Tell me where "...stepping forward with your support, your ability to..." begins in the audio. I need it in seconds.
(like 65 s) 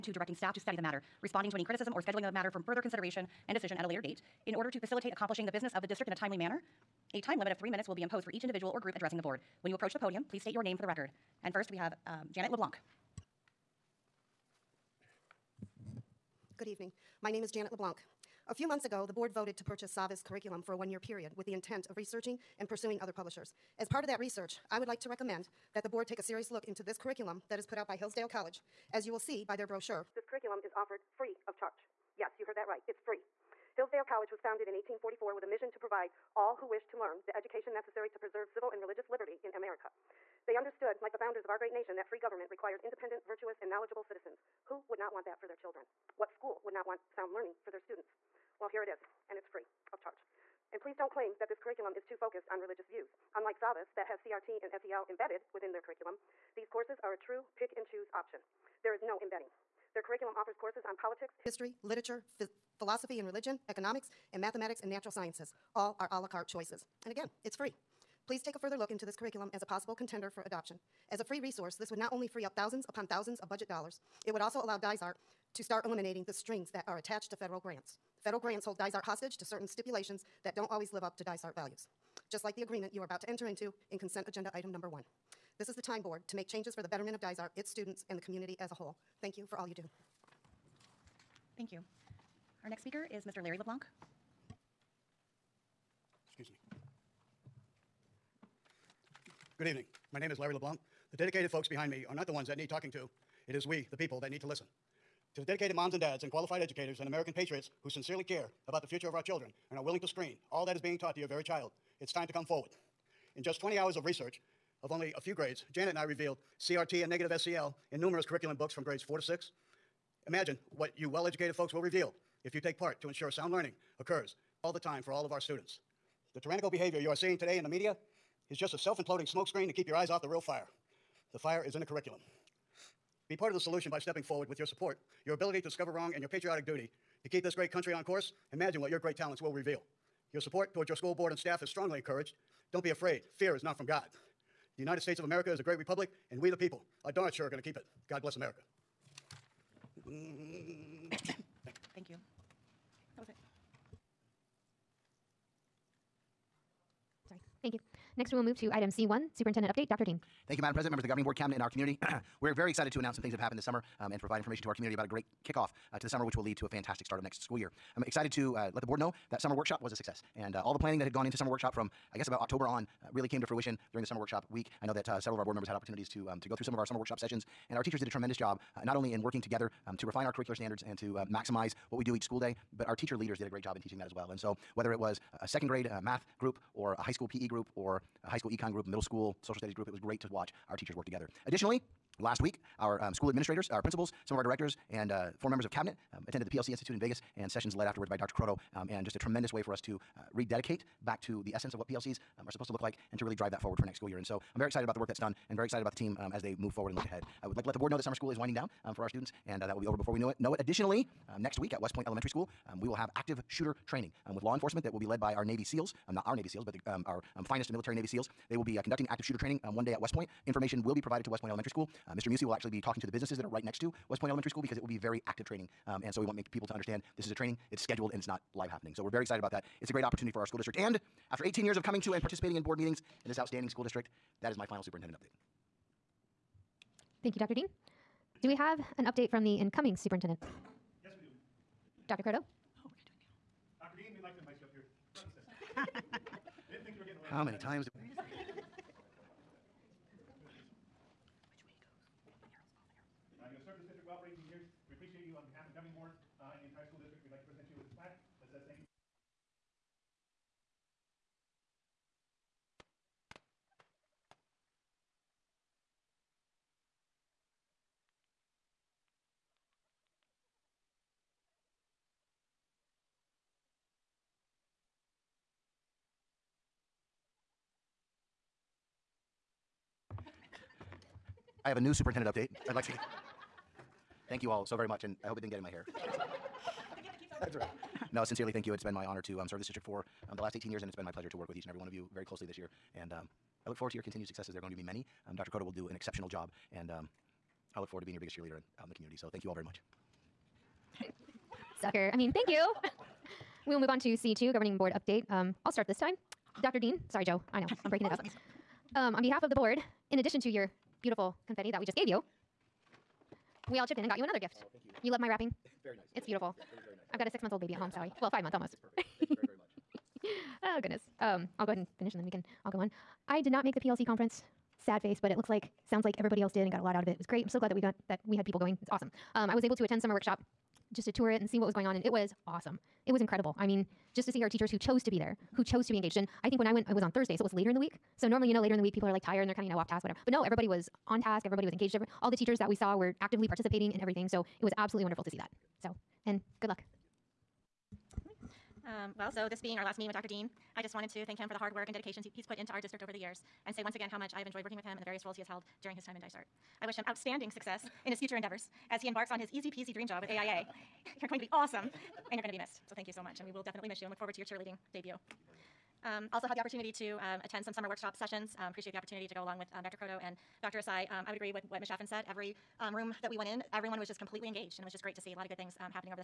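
133 s.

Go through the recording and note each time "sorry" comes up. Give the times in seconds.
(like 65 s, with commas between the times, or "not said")
157 s, 307 s, 317 s.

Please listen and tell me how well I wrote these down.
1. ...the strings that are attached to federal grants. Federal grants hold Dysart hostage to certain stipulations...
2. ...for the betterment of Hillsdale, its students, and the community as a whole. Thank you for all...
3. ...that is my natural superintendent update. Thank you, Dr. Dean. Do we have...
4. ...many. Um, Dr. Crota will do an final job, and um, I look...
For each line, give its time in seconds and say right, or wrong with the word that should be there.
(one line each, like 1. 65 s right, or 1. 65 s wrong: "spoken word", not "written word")
1. 76 s right
2. 86 s wrong: "Dysart", not "Hillsdale"
3. 234 s wrong: "final", not "natural"
4. 294 s wrong: "exceptional", not "final".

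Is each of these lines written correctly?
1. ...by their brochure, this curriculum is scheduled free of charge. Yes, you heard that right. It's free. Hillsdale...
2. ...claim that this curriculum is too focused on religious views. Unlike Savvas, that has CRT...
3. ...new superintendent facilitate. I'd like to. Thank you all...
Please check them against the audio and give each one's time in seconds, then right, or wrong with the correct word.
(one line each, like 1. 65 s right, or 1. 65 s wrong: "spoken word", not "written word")
1. 29 s wrong: "offered", not "scheduled"
2. 51 s right
3. 281 s wrong: "update", not "facilitate".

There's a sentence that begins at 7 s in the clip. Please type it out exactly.
A time limit of three minutes will be imposed for each individual or group addressing the board.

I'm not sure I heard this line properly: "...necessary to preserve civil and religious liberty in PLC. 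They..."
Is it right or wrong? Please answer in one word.
wrong.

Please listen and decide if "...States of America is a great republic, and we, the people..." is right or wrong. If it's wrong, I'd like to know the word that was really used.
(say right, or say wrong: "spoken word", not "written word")
right.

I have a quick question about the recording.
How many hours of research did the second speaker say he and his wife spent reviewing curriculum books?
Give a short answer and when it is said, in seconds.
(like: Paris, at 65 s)
20, at 113 s.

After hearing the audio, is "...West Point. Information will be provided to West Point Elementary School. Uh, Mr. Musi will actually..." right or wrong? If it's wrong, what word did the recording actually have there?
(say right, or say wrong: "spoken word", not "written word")
right.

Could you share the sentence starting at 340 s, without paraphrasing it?
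But no, everybody was on task.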